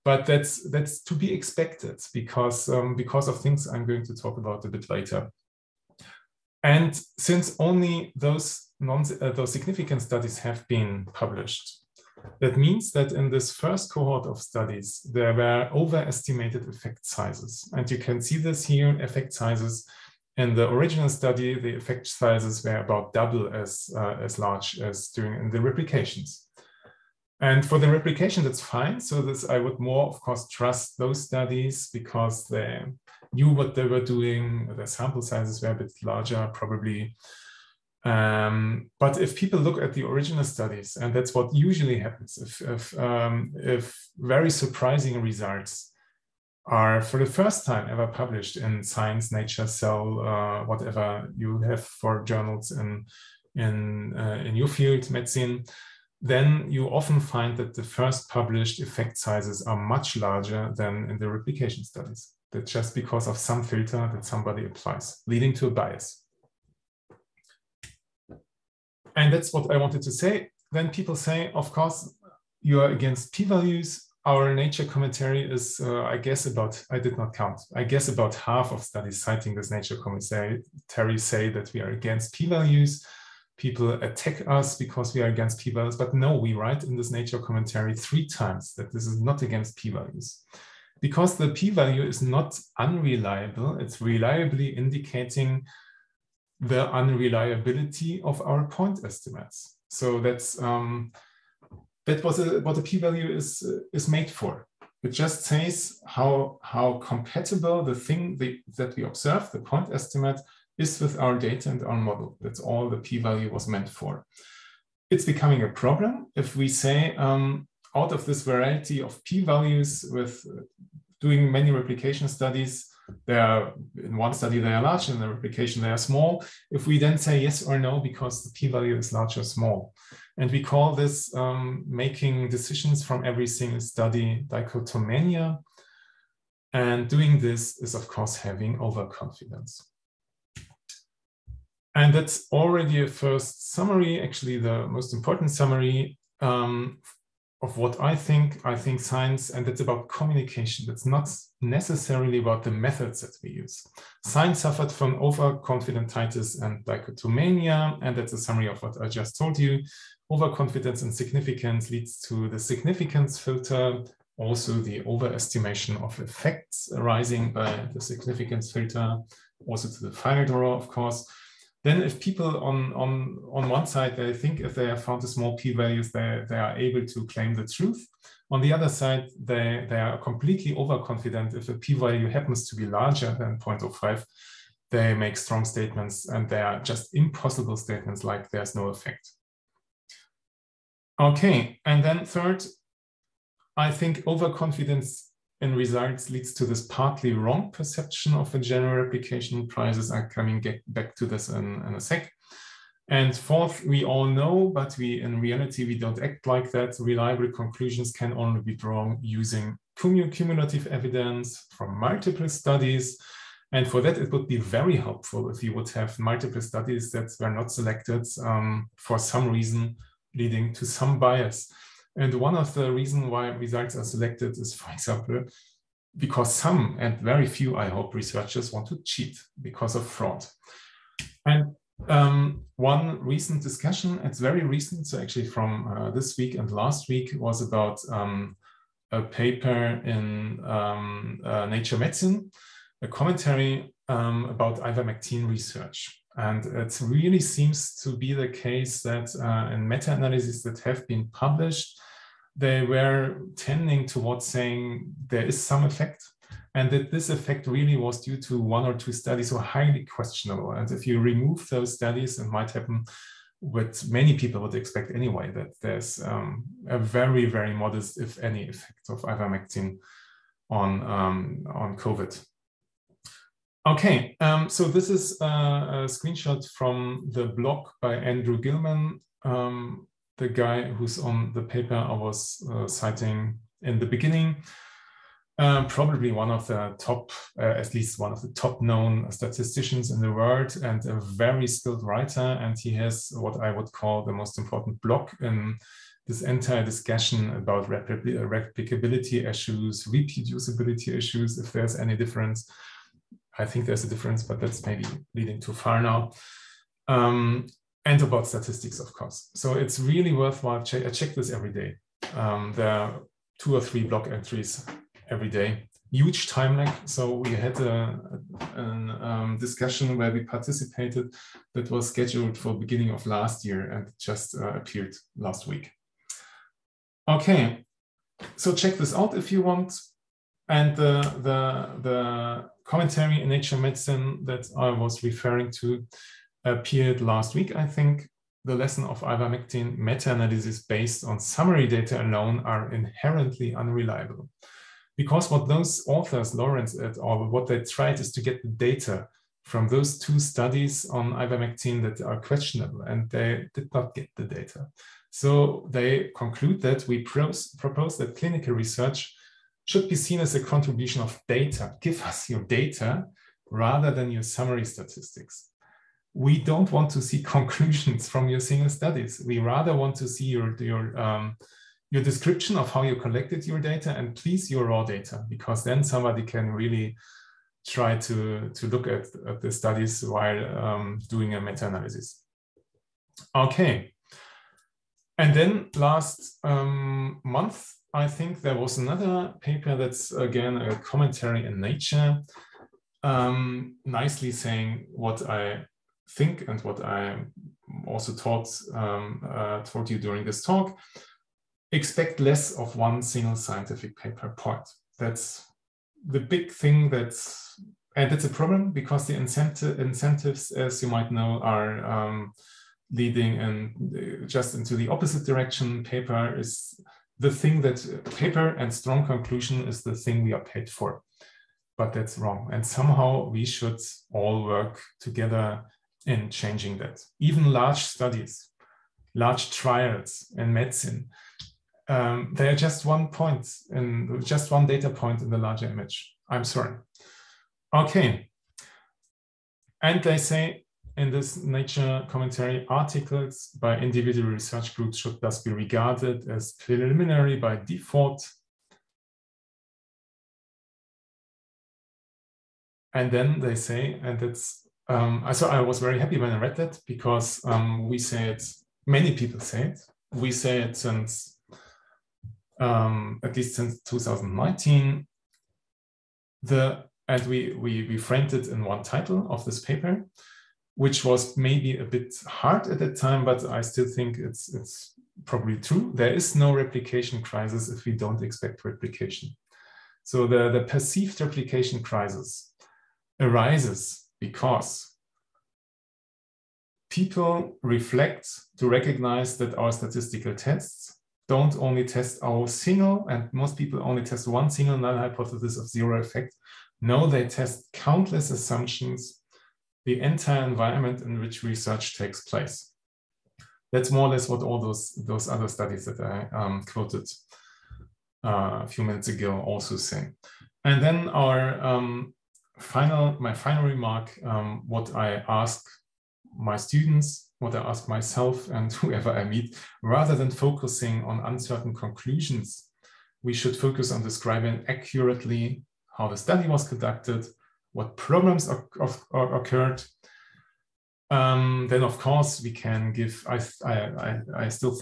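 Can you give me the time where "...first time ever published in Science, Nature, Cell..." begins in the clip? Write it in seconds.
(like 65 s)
47 s.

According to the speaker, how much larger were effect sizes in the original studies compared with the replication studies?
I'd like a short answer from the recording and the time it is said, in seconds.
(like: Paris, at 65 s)
About double, at 22 s.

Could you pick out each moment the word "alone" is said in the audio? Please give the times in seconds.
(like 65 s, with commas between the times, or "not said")
342 s.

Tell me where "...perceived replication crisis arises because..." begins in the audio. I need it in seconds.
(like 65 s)
480 s.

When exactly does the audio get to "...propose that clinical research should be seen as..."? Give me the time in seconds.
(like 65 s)
357 s.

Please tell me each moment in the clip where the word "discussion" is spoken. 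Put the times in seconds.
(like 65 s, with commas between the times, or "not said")
233 s, 296 s, 319 s.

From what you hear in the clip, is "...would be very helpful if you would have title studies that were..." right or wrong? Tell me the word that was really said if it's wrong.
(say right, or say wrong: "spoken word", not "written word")
wrong: "multiple", not "title".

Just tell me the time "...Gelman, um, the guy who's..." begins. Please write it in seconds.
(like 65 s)
278 s.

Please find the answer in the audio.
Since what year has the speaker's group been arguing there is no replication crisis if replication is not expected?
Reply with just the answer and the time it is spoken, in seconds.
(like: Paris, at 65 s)
2019, at 464 s.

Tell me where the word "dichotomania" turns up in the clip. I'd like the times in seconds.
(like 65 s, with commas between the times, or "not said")
134 s, 156 s.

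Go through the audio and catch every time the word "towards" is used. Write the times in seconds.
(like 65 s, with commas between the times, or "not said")
254 s.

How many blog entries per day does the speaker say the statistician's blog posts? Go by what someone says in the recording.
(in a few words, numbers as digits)
2 or 3.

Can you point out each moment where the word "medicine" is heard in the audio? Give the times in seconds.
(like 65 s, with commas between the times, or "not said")
55 s, 241 s, 333 s, 430 s.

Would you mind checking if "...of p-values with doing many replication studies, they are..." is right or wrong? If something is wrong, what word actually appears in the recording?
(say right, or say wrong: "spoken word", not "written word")
right.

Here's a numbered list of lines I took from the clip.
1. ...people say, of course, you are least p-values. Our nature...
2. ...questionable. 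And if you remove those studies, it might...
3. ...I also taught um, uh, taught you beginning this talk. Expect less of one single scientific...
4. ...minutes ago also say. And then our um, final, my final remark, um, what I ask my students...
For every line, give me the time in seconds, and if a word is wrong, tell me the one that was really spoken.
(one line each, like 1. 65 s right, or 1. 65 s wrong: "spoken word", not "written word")
1. 70 s wrong: "against", not "least"
2. 260 s right
3. 397 s wrong: "during", not "beginning"
4. 509 s right.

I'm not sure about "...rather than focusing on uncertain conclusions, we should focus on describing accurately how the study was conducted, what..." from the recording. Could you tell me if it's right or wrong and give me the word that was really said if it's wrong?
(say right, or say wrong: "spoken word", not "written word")
right.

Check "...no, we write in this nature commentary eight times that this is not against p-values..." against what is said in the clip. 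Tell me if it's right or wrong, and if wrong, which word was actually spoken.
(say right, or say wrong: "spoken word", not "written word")
wrong: "three", not "eight".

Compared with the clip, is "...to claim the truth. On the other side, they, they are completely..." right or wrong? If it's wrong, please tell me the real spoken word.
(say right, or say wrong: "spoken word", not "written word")
right.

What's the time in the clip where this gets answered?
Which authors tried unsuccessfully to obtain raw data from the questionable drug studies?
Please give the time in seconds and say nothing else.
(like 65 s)
346 s.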